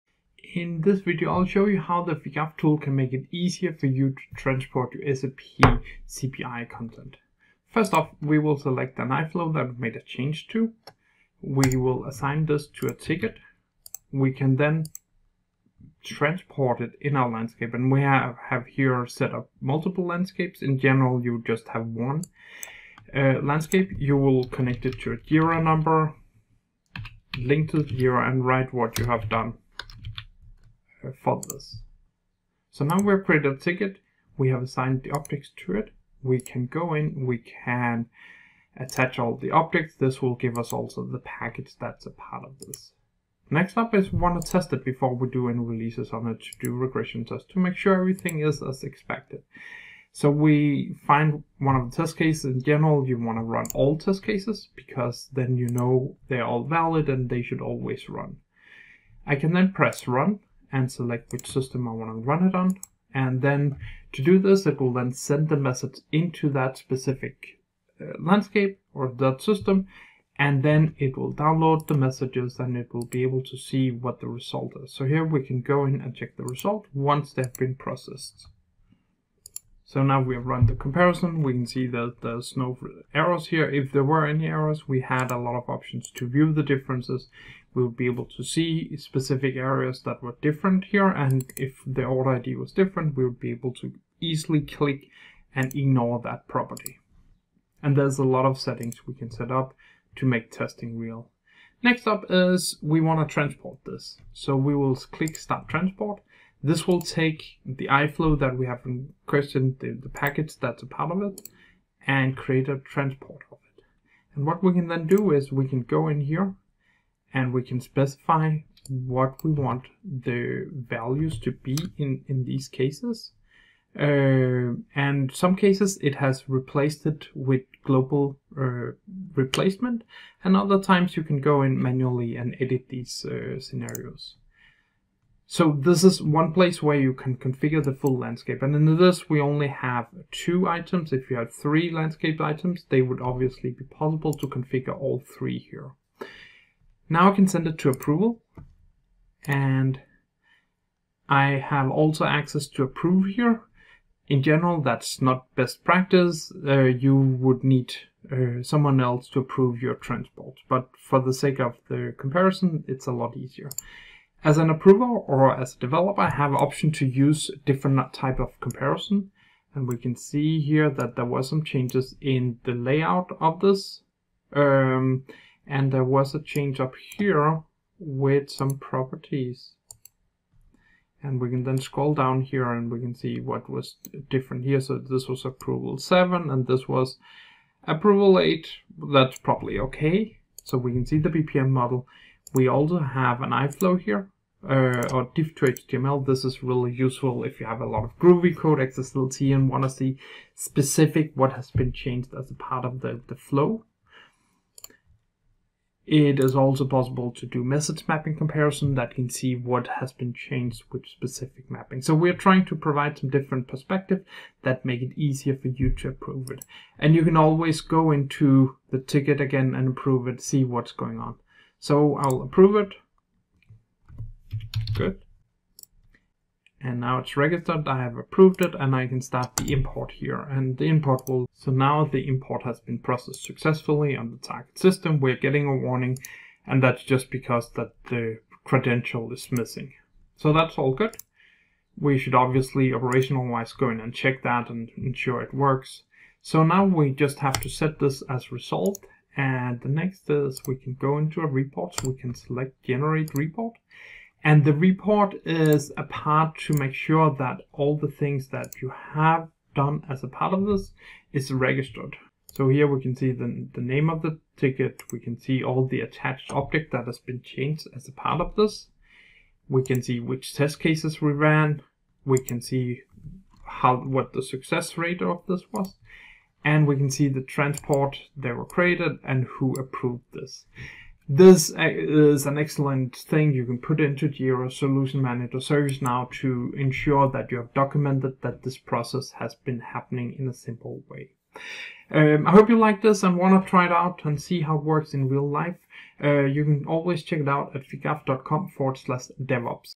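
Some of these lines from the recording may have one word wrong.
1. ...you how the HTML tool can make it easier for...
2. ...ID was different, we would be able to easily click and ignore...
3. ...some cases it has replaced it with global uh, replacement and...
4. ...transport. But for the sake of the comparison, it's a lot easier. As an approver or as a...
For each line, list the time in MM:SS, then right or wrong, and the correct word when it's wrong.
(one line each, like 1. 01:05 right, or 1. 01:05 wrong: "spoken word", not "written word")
1. 00:01 wrong: "Figaf", not "HTML"
2. 01:32 right
3. 02:05 right
4. 02:39 right.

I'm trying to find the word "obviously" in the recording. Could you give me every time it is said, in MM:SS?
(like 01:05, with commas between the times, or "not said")
02:23, 04:02.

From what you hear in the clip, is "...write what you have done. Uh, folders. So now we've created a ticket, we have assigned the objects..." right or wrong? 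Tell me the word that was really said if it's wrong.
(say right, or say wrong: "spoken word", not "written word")
right.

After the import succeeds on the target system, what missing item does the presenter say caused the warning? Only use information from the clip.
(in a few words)
the credential.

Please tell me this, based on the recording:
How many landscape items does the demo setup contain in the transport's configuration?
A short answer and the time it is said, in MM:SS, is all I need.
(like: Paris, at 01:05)
2, at 02:20.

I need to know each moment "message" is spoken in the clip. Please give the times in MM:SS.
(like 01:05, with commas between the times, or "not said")
01:05, 01:11, 03:27.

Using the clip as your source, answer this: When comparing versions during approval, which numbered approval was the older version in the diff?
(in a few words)
approval 7.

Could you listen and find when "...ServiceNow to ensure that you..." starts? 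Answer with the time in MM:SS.
04:45.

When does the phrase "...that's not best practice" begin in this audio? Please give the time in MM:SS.
02:34.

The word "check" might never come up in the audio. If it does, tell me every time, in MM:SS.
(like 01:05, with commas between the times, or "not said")
01:16, 04:04, 04:57.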